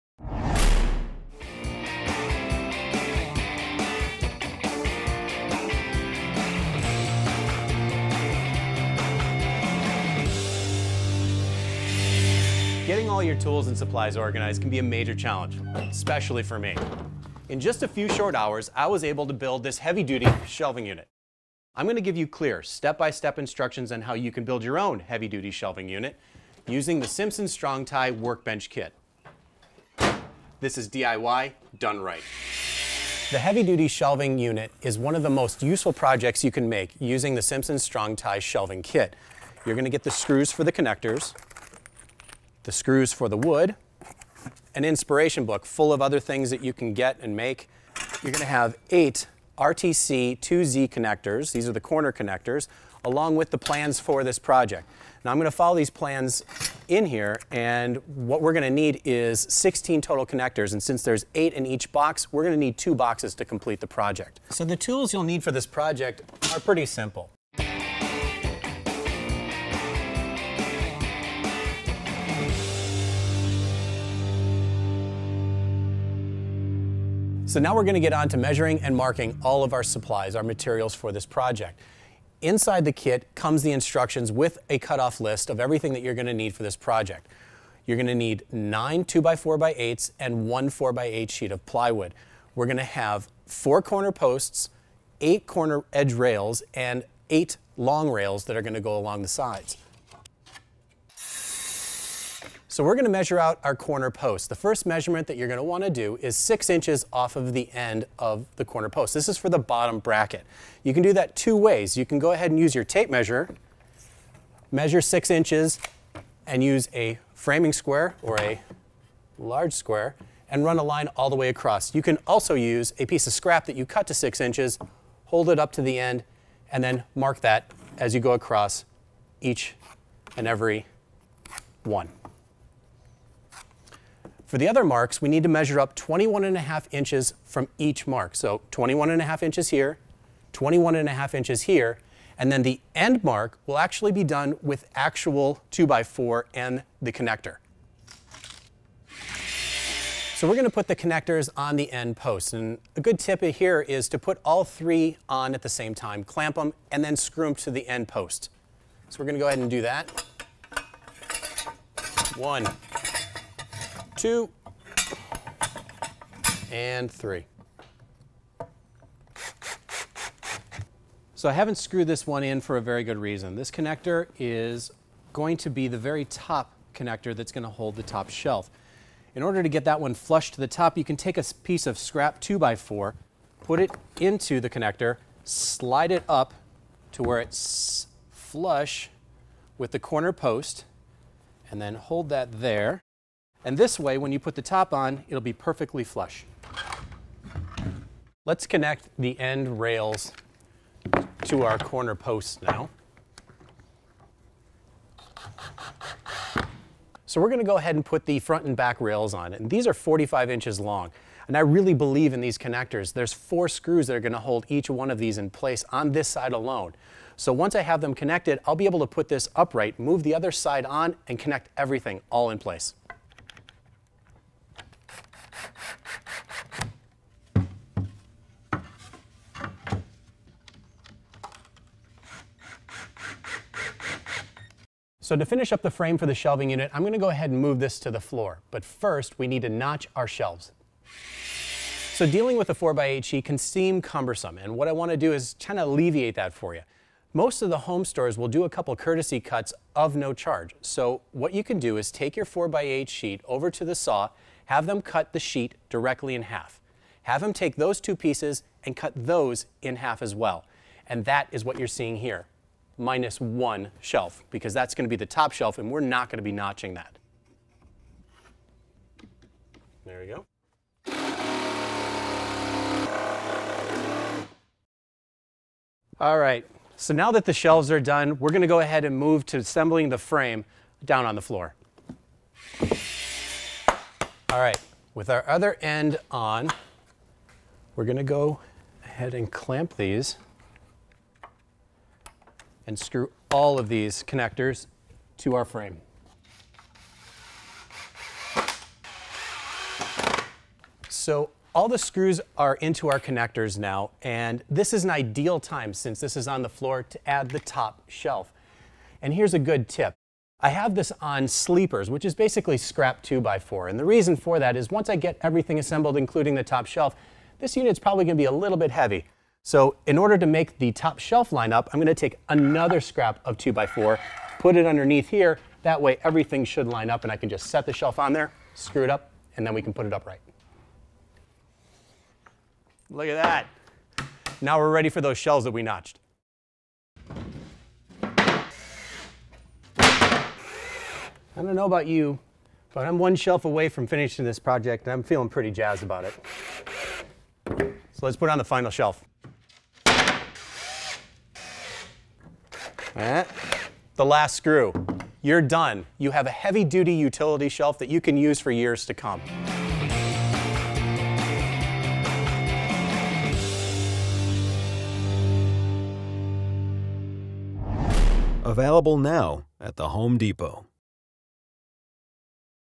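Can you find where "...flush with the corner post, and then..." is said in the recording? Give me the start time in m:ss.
3:08.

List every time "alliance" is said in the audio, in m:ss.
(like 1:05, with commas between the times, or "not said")
not said.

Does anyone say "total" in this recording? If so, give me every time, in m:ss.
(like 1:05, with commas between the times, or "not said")
1:00.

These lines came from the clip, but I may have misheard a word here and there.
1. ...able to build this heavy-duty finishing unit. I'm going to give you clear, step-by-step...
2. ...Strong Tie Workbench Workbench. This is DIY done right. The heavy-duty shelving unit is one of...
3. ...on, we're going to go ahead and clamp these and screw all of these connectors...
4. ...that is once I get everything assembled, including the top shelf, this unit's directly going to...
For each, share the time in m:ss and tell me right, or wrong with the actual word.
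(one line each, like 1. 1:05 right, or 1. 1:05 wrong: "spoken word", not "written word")
1. 0:19 wrong: "shelving", not "finishing"
2. 0:27 wrong: "Kit", not "Workbench"
3. 4:46 right
4. 5:14 wrong: "probably", not "directly".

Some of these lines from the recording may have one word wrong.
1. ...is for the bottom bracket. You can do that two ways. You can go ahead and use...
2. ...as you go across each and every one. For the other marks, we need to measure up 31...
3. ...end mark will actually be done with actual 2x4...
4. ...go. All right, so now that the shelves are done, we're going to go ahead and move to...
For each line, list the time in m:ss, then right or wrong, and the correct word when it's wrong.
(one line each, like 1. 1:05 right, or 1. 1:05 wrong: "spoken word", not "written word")
1. 1:49 right
2. 2:07 wrong: "21", not "31"
3. 2:22 right
4. 4:30 right.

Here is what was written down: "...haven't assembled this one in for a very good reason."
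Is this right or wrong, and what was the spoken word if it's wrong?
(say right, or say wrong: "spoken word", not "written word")
wrong: "screwed", not "assembled".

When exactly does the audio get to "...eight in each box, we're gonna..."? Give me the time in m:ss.
1:01.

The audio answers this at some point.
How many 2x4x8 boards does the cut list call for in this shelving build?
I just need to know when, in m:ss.
1:28.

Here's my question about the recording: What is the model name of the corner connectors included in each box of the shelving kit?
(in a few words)
RTC 2Z.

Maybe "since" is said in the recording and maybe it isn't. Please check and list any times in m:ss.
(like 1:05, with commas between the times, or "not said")
1:00, 5:05.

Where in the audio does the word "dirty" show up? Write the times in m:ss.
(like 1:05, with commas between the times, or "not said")
not said.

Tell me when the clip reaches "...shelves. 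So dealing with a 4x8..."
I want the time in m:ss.
4:00.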